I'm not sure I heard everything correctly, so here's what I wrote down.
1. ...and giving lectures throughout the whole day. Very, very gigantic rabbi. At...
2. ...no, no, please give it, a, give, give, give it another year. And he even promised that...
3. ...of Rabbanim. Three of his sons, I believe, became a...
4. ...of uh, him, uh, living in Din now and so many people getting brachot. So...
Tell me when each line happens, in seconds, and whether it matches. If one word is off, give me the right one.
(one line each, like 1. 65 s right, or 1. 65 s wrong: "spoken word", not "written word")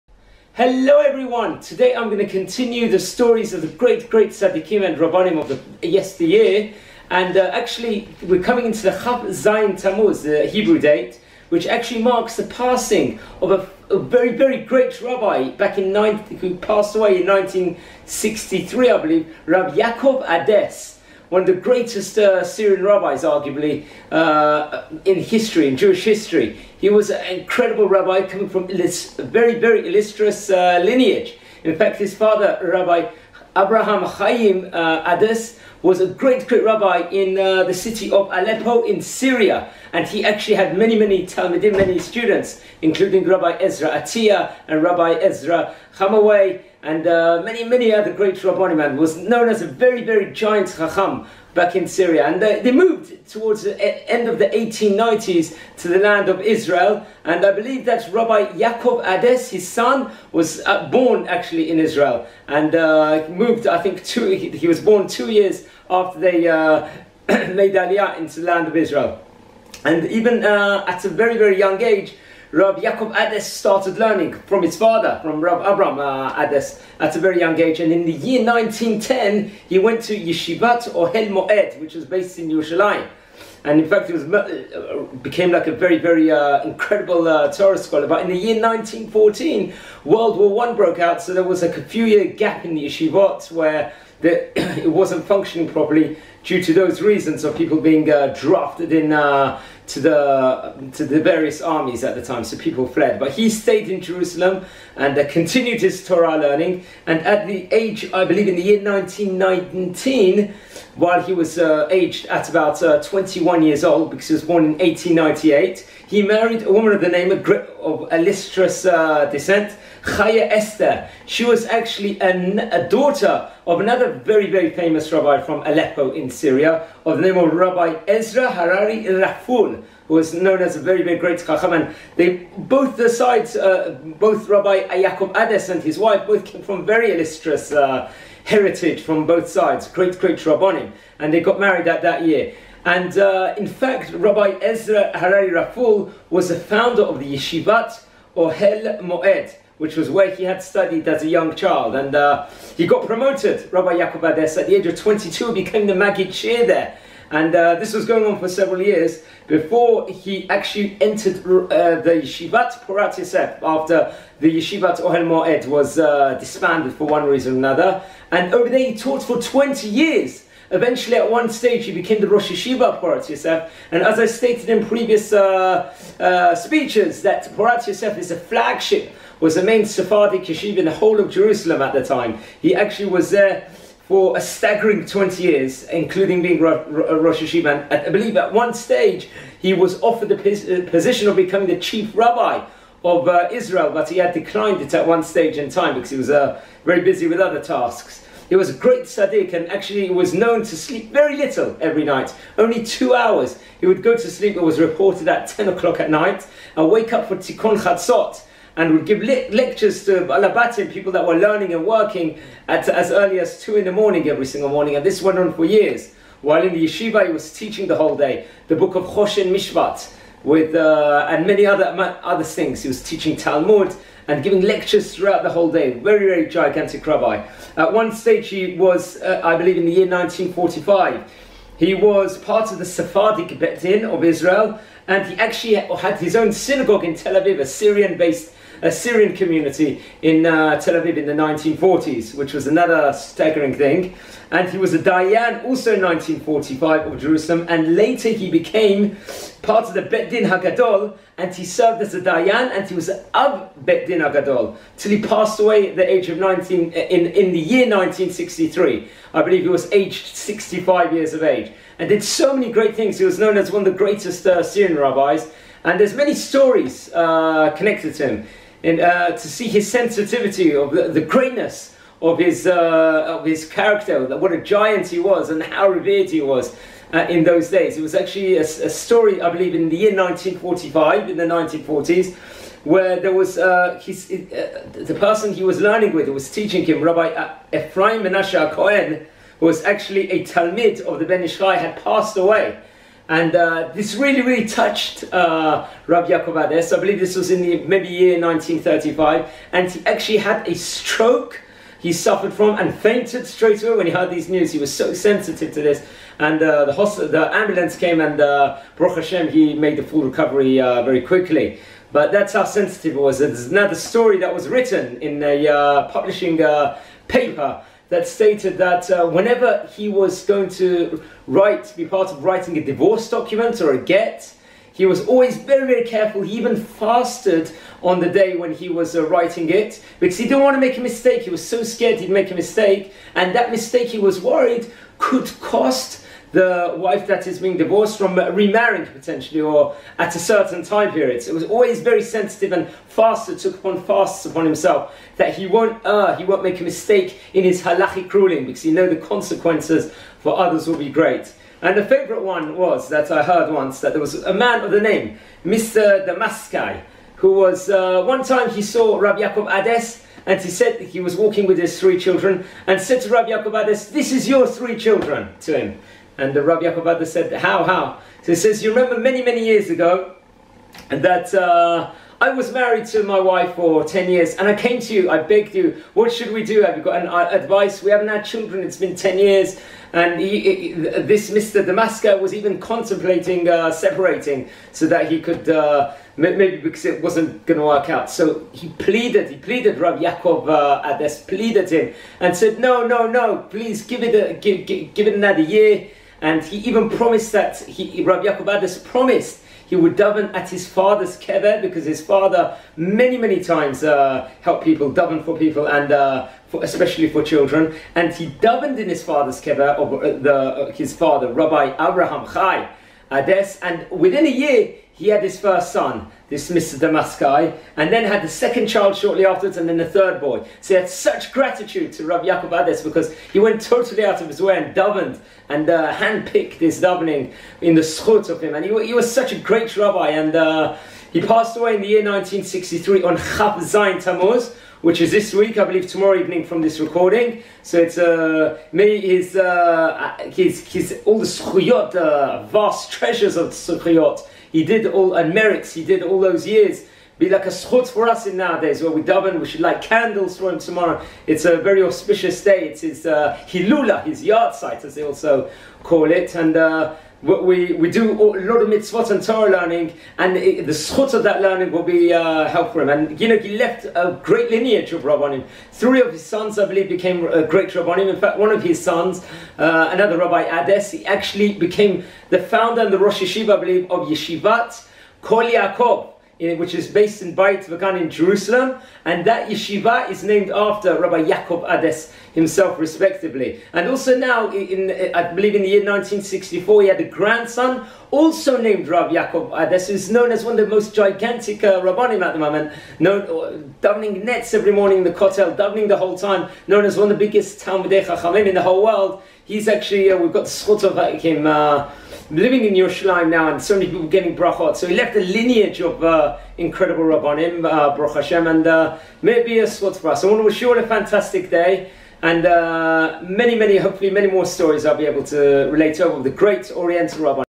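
1. 224 s right
2. 393 s right
3. 465 s right
4. 501 s wrong: "Yerushalayim", not "Din".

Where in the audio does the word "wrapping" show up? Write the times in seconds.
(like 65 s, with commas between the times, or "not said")
not said.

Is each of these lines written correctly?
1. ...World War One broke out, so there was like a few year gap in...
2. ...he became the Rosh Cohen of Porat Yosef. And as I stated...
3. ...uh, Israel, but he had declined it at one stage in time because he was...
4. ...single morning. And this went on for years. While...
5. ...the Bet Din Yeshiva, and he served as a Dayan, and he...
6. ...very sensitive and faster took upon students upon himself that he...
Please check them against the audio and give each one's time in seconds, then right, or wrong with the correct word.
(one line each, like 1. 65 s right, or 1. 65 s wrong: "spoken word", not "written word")
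1. 90 s right
2. 171 s wrong: "Yeshiva", not "Cohen"
3. 193 s right
4. 214 s right
5. 249 s wrong: "Hagadol", not "Yeshiva"
6. 342 s wrong: "fasts", not "students".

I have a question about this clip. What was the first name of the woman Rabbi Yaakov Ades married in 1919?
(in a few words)
Chaya Esther.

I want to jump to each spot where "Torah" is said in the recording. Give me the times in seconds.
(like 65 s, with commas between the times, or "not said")
87 s, 106 s, 459 s.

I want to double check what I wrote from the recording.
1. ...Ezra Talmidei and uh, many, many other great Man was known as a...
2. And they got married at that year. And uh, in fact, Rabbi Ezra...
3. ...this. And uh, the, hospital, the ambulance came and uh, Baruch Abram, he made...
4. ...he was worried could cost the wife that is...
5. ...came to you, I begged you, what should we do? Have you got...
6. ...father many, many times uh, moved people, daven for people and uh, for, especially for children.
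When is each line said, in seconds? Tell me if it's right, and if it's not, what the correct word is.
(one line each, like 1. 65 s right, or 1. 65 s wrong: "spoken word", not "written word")
1. 45 s wrong: "Chamawi", not "Talmidei"
2. 141 s right
3. 305 s wrong: "Hashem", not "Abram"
4. 334 s right
5. 374 s right
6. 402 s wrong: "helped", not "moved".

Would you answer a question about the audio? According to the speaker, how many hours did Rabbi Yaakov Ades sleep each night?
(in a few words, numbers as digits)
2.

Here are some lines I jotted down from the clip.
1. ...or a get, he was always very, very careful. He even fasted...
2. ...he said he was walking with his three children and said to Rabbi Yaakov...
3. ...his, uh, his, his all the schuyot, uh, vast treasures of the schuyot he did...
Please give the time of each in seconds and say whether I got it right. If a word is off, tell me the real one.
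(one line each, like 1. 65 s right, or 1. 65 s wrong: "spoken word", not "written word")
1. 323 s right
2. 360 s right
3. 439 s right.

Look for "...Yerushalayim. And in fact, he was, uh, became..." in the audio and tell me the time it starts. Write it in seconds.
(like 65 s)
82 s.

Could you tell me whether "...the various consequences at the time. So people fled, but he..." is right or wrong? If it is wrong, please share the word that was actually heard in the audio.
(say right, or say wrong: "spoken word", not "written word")
wrong: "armies", not "consequences".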